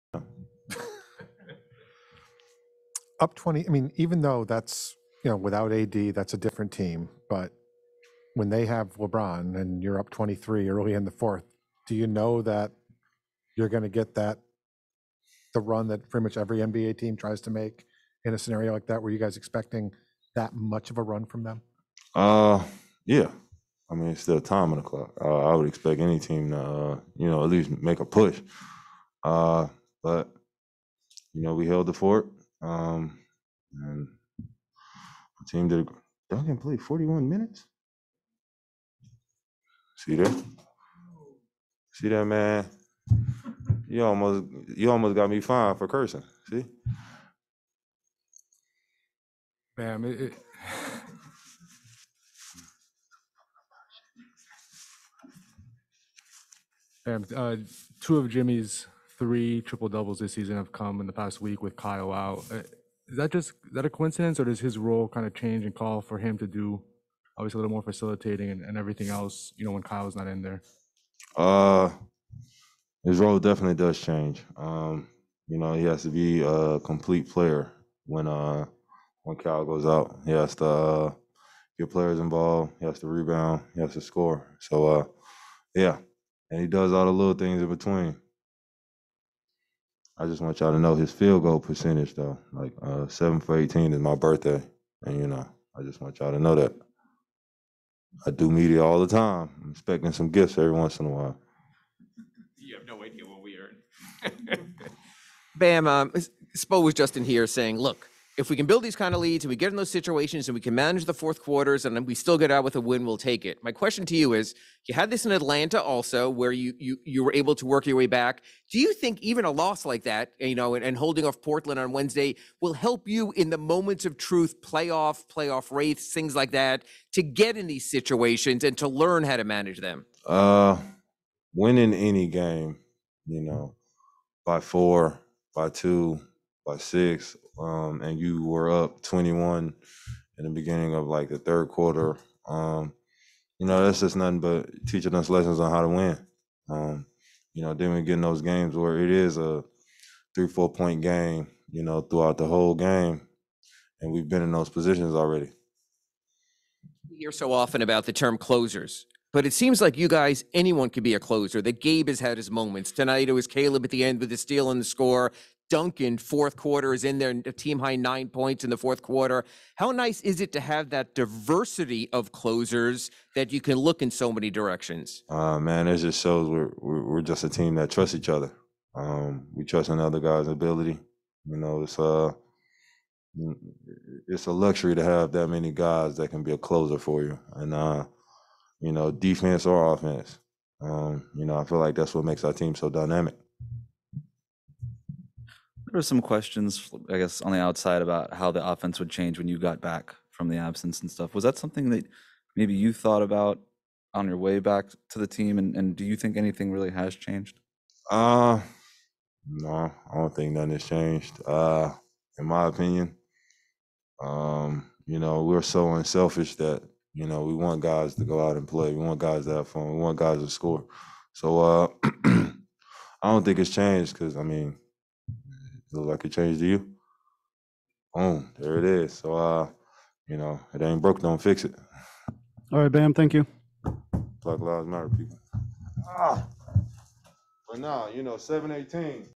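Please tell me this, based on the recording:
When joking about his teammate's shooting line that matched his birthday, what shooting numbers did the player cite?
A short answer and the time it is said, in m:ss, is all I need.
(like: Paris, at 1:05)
7 for 18, at 1:33.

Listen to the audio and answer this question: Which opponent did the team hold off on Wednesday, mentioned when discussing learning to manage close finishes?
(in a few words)
Portland.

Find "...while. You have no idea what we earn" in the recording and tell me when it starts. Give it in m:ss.
1:41.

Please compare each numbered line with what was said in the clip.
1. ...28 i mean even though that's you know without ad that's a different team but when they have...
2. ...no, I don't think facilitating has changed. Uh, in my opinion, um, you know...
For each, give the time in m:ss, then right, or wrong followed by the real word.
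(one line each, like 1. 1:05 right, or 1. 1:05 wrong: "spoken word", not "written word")
1. 0:03 wrong: "20", not "28"
2. 3:29 wrong: "nothing", not "facilitating".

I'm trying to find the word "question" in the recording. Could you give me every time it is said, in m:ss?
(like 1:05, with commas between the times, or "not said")
1:53, 3:16.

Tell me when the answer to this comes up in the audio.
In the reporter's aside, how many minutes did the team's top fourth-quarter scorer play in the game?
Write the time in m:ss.
0:36.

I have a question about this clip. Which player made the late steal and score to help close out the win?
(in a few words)
Caleb.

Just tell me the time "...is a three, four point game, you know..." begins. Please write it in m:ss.
2:29.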